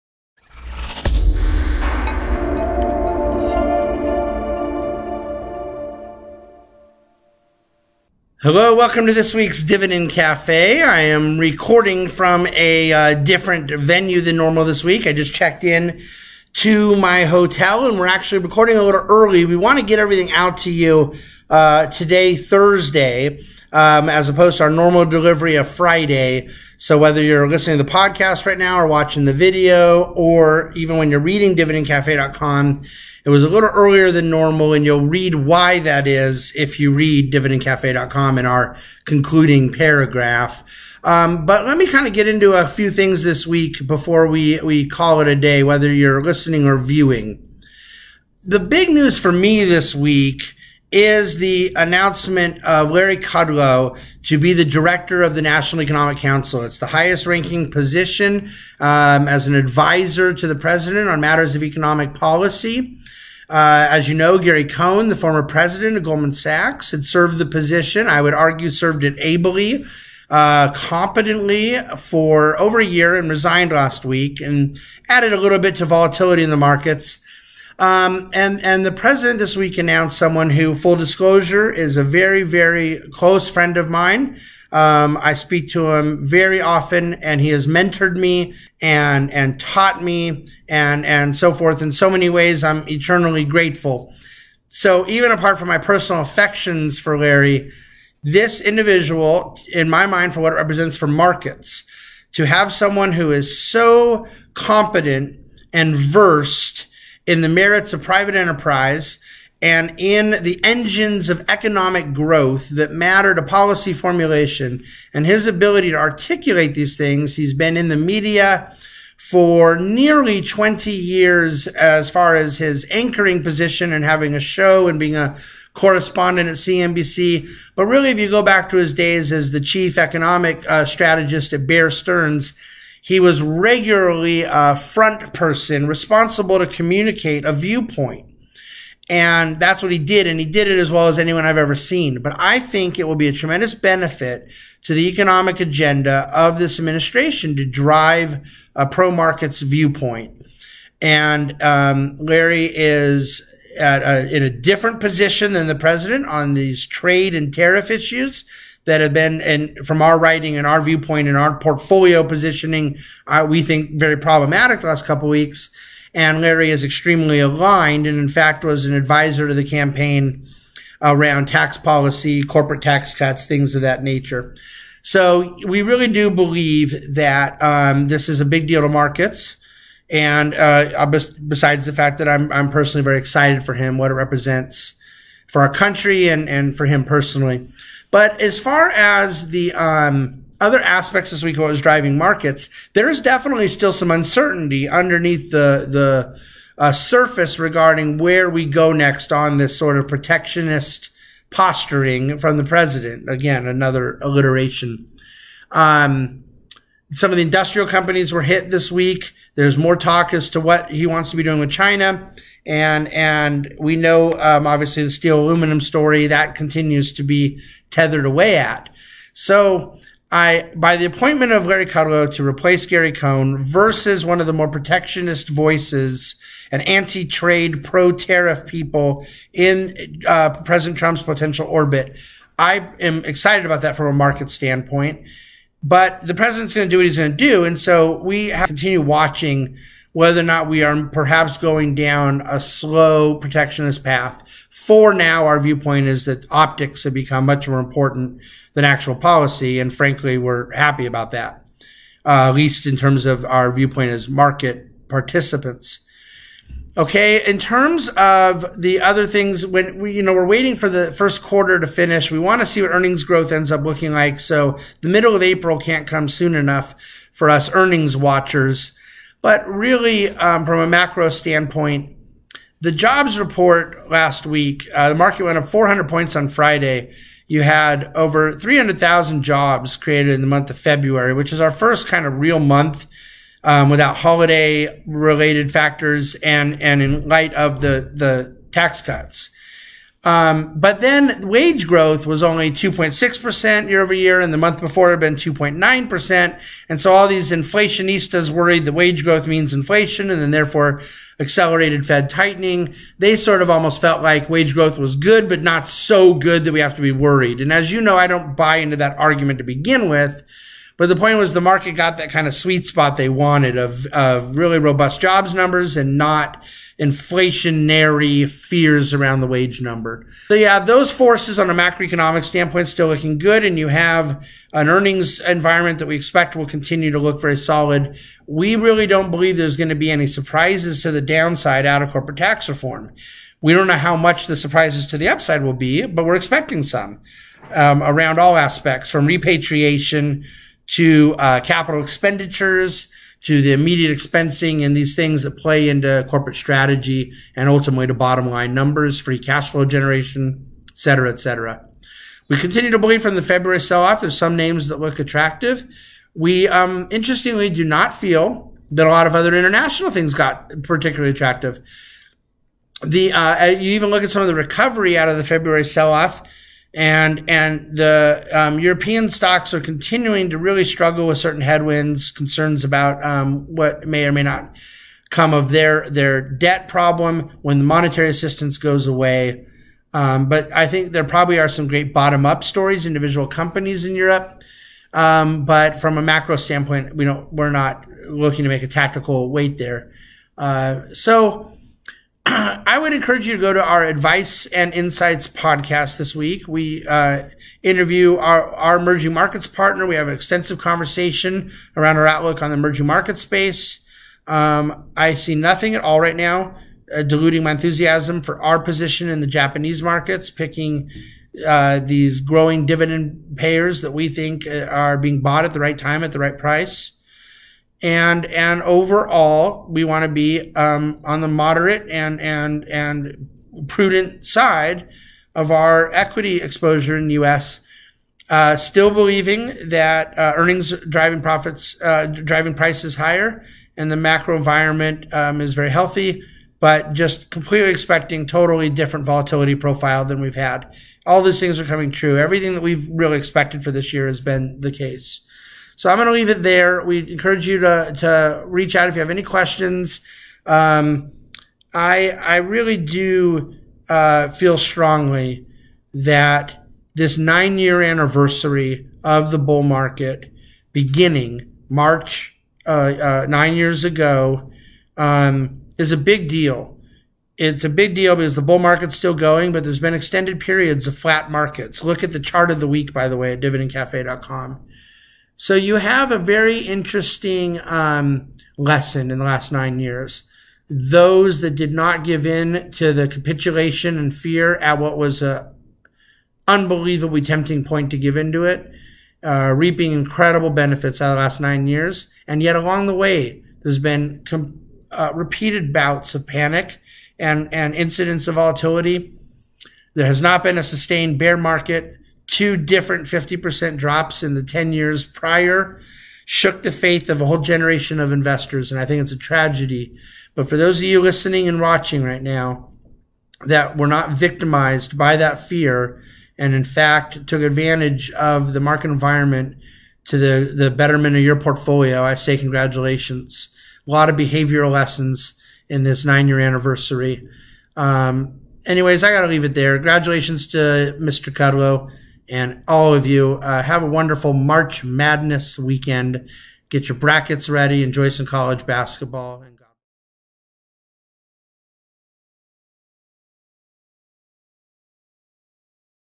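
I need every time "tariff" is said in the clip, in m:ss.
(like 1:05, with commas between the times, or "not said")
2:37, 3:47.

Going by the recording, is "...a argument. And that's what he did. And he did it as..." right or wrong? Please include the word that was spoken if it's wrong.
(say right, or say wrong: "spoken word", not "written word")
wrong: "viewpoint", not "argument".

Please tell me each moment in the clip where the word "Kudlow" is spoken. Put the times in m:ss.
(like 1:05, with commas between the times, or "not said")
0:53, 3:41, 8:51.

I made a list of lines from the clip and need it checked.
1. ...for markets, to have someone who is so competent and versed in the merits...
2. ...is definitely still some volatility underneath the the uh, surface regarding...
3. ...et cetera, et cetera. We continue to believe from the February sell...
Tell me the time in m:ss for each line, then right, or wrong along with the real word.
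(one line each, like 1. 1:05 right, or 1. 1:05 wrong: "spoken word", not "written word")
1. 1:40 right
2. 3:13 wrong: "uncertainty", not "volatility"
3. 5:50 right.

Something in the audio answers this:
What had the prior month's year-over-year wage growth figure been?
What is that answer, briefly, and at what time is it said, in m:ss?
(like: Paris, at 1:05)
2.9%, at 4:55.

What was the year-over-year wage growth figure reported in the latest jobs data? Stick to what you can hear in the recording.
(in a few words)
2.6%.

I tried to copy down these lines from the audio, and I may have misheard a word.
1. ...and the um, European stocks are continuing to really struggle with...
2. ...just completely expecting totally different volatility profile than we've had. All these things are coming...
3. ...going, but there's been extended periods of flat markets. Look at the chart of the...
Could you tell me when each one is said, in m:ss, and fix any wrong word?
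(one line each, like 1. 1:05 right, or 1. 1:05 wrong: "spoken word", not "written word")
1. 6:07 right
2. 7:17 right
3. 7:49 right.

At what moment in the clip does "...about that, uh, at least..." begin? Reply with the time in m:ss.
4:11.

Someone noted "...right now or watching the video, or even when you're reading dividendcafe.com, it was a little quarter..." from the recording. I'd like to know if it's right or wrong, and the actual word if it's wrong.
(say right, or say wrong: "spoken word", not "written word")
wrong: "earlier", not "quarter".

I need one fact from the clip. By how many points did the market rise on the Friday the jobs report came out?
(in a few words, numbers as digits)
400.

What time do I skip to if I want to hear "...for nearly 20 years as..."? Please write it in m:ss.
1:59.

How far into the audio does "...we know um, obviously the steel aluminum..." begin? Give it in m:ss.
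3:33.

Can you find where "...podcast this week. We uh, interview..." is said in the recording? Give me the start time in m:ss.
6:35.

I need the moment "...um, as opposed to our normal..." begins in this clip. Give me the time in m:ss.
0:23.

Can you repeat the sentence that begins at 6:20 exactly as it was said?
Um, but I think there probably are some great bottom up stories, individual companies in Europe.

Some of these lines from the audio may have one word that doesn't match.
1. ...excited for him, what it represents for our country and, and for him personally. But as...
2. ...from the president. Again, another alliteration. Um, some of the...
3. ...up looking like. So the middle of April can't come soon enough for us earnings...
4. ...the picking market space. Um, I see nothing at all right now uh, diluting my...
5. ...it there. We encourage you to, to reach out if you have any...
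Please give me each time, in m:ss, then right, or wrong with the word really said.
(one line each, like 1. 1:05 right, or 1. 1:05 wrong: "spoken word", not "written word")
1. 3:03 right
2. 3:22 right
3. 4:23 right
4. 6:42 wrong: "emerging", not "picking"
5. 7:26 right.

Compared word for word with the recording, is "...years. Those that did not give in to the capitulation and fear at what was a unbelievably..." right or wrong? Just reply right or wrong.
right.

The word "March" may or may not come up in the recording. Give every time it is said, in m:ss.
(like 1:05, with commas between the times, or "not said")
7:41, 8:54.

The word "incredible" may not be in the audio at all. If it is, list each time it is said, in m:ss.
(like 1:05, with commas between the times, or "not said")
8:10.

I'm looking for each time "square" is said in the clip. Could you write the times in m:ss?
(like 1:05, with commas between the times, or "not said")
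not said.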